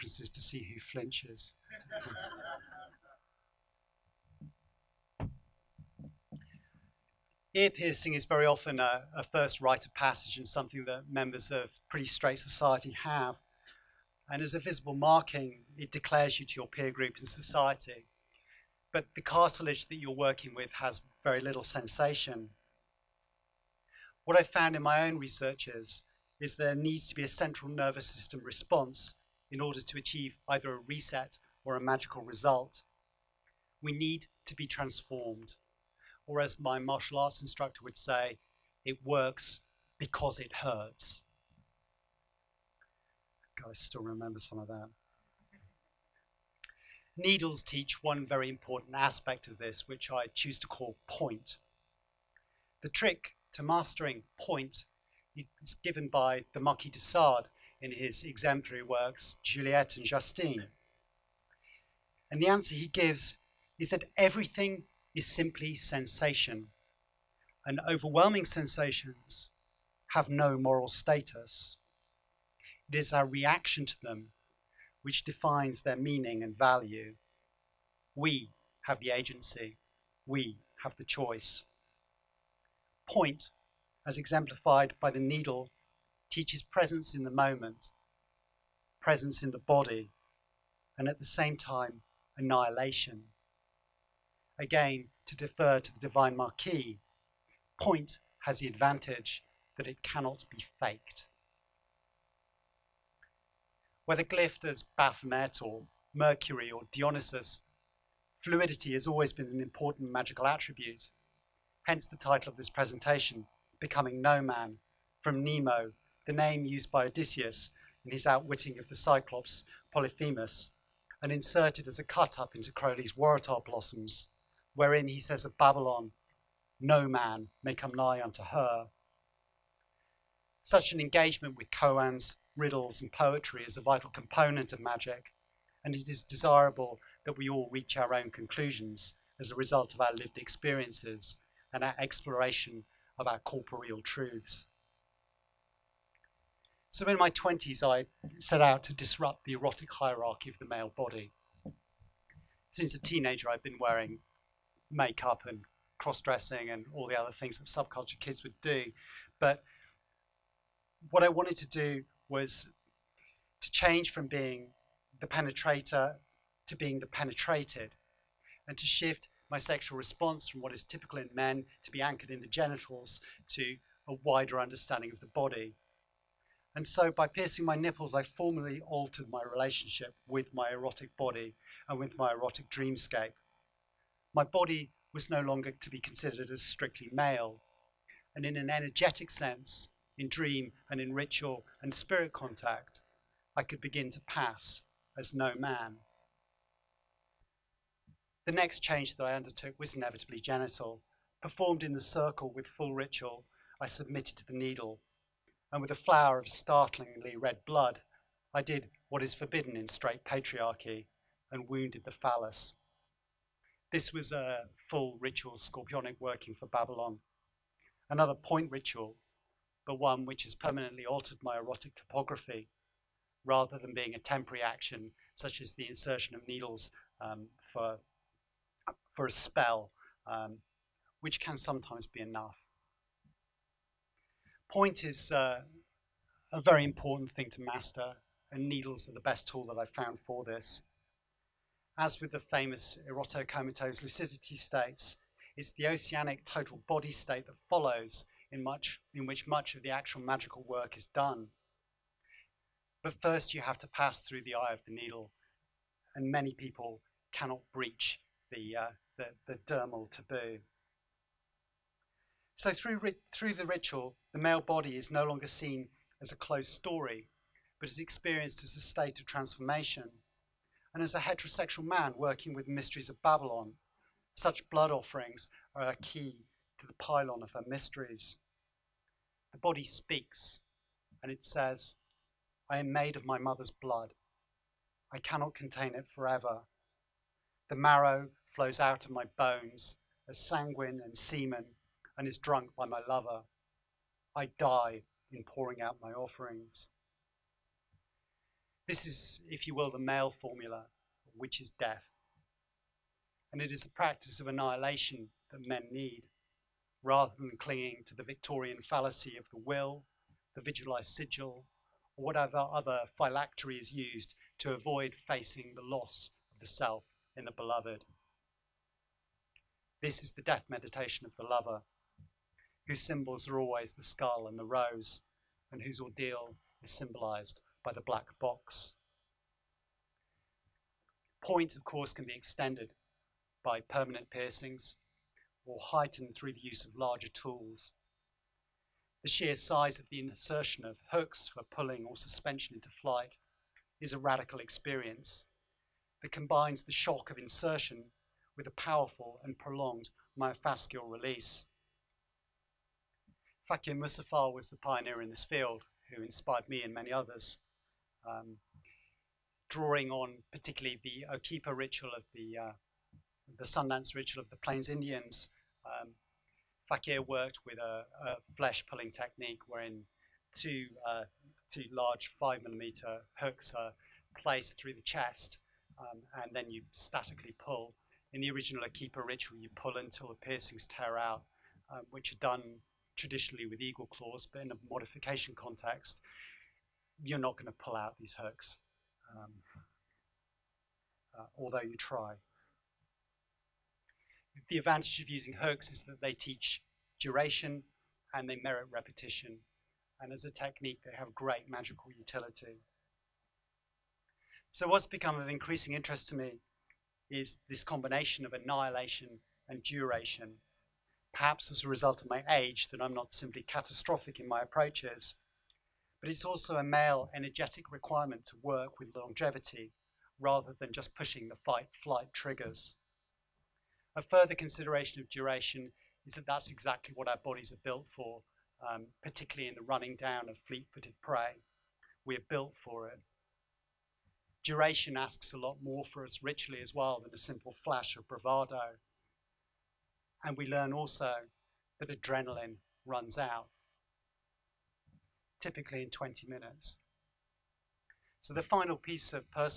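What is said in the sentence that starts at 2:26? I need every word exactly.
So in my 20s, I set out to disrupt the erotic hierarchy of the male body.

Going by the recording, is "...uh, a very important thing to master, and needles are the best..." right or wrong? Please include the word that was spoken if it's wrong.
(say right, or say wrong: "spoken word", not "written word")
right.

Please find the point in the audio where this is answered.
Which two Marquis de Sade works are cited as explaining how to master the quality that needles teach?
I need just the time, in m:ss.
0:59.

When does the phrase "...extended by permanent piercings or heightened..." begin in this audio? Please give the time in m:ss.
5:32.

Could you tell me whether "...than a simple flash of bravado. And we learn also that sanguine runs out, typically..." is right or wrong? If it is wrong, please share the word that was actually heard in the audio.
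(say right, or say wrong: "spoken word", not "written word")
wrong: "adrenaline", not "sanguine".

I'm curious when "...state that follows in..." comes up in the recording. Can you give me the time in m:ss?
4:07.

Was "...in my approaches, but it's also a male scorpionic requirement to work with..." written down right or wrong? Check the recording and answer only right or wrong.
wrong.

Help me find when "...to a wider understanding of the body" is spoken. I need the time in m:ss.
2:53.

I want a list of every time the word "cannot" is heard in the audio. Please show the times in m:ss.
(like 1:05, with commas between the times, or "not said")
1:40, 4:17, 4:45.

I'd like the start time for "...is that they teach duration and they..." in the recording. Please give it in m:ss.
6:35.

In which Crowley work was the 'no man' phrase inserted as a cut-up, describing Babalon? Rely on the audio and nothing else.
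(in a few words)
Waratah Blossoms.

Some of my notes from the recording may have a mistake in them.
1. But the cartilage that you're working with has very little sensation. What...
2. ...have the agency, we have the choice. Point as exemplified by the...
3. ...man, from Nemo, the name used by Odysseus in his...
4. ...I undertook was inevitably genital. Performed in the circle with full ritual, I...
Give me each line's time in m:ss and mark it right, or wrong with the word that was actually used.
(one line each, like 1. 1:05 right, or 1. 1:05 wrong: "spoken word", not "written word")
1. 0:18 right
2. 1:18 right
3. 1:54 right
4. 3:19 right.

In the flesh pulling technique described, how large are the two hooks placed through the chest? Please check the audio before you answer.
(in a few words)
5 millimeters.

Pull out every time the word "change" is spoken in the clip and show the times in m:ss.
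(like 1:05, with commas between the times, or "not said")
2:43, 3:18.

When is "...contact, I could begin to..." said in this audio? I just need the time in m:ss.
3:12.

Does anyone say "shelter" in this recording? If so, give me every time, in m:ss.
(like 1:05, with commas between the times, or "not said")
not said.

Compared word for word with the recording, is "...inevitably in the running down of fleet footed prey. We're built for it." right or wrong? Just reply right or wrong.
wrong.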